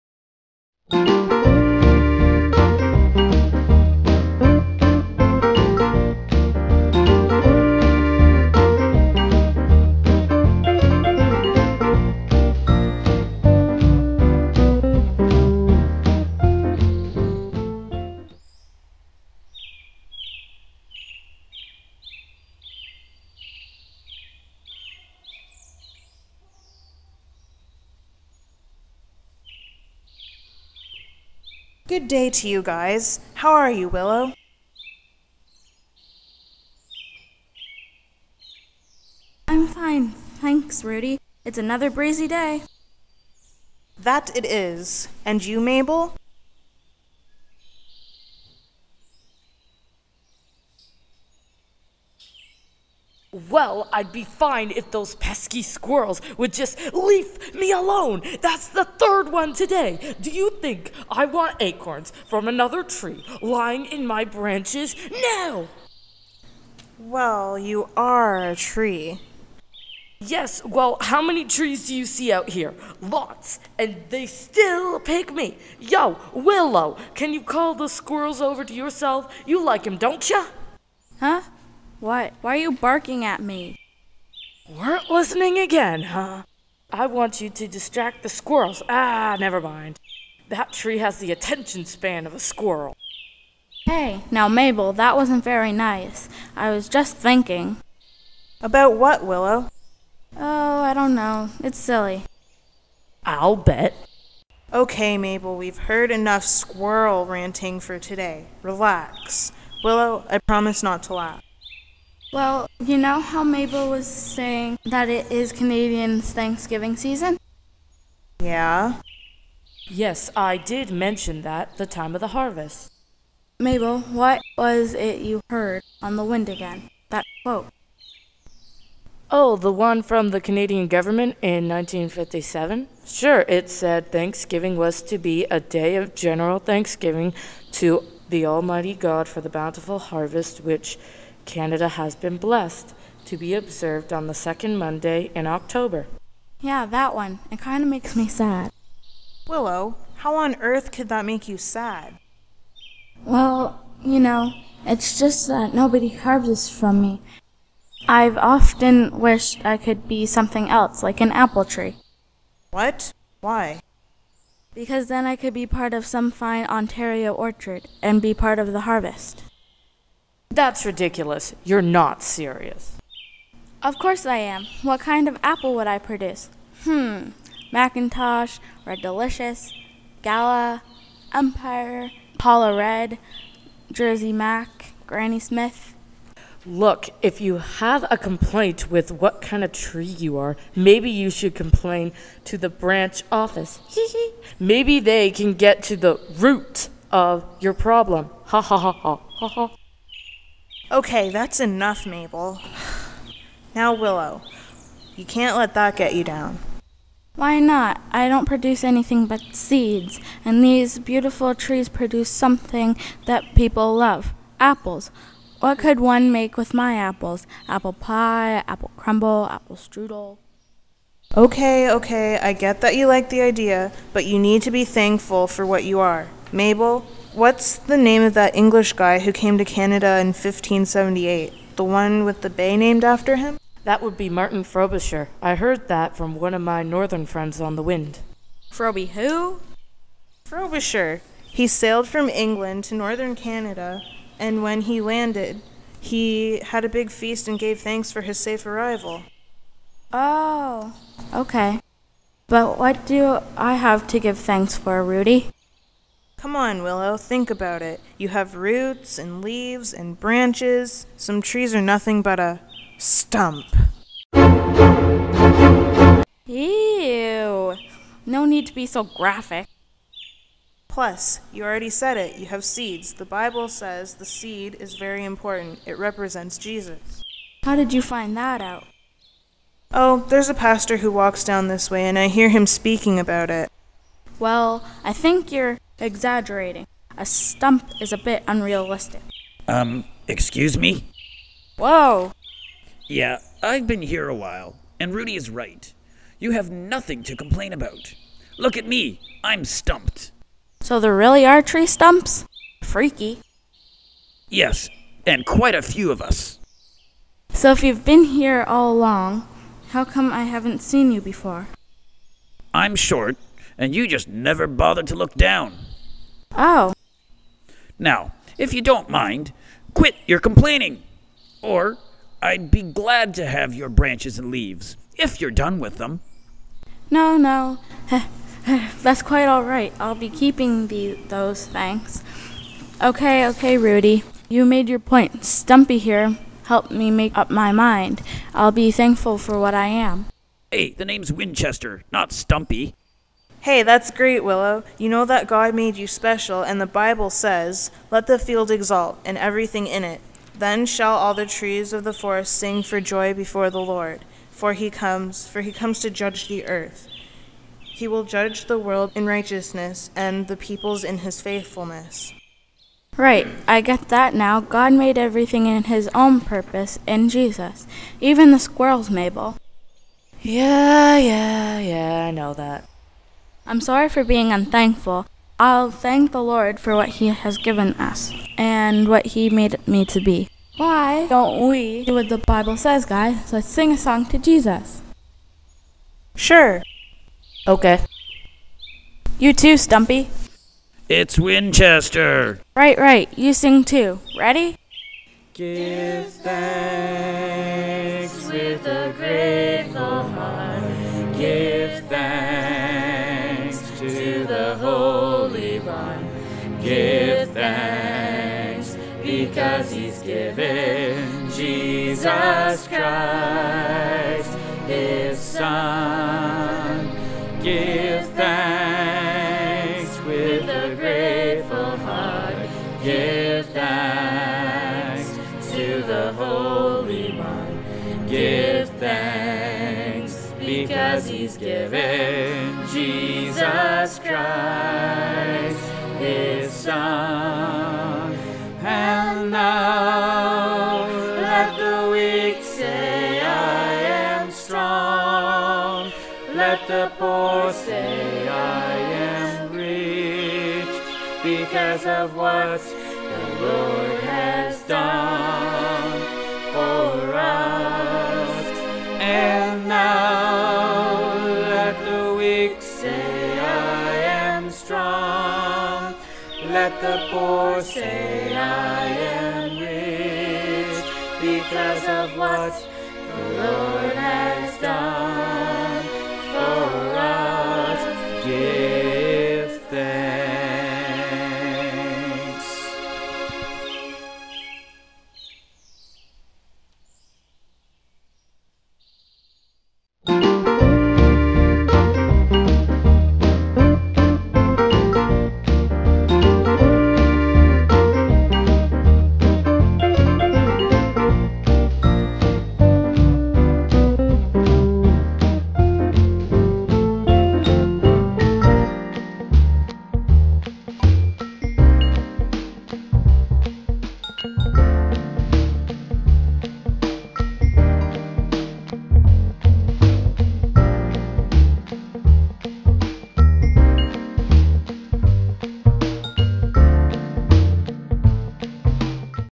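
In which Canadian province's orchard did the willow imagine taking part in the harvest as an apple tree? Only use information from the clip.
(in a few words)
Ontario.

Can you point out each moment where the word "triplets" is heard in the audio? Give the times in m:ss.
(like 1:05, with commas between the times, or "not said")
not said.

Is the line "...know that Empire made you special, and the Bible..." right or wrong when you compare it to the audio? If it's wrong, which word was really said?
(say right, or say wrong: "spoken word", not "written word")
wrong: "God", not "Empire".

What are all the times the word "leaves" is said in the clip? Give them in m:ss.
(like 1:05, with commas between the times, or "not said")
0:56, 4:19, 5:24.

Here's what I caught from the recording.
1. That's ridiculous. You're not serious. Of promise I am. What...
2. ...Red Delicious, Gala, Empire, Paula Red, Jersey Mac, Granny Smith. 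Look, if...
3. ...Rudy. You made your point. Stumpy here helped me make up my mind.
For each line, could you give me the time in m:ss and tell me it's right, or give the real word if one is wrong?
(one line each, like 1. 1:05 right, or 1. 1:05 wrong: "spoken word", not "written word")
1. 2:50 wrong: "course", not "promise"
2. 2:58 right
3. 5:33 right.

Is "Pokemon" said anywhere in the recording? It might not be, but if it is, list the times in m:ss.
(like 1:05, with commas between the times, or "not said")
not said.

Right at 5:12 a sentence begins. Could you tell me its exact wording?
I'm short, and you just never bothered to look down.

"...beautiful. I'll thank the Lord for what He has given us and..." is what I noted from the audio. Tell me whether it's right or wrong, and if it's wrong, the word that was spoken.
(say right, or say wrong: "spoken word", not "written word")
wrong: "unthankful", not "beautiful".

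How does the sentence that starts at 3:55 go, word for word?
I heard that from one of my northern friends on the wind.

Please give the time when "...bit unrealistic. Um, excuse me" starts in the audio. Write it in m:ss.
4:48.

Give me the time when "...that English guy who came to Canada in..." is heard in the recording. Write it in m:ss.
3:48.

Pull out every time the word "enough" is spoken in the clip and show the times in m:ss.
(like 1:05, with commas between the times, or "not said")
1:46, 3:21.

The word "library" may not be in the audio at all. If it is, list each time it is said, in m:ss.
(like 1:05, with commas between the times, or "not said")
not said.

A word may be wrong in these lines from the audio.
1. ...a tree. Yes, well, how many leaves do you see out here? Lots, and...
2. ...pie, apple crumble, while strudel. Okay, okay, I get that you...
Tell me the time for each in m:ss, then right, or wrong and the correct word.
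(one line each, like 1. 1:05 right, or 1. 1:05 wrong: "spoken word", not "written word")
1. 1:08 wrong: "trees", not "leaves"
2. 3:37 wrong: "apple", not "while".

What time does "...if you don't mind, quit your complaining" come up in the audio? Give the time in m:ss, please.
5:18.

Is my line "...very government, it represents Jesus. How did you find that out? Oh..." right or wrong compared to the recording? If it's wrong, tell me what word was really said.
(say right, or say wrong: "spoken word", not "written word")
wrong: "important", not "government".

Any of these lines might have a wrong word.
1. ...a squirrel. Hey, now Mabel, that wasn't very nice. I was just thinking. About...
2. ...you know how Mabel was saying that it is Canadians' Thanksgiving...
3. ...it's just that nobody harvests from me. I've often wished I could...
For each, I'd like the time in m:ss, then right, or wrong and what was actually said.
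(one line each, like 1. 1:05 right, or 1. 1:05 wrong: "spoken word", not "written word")
1. 1:32 right
2. 1:52 right
3. 2:34 right.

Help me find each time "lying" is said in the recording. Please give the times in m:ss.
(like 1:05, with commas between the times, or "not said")
1:03.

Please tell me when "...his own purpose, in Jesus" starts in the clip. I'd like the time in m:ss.
6:05.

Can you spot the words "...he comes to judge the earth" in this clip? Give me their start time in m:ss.
5:55.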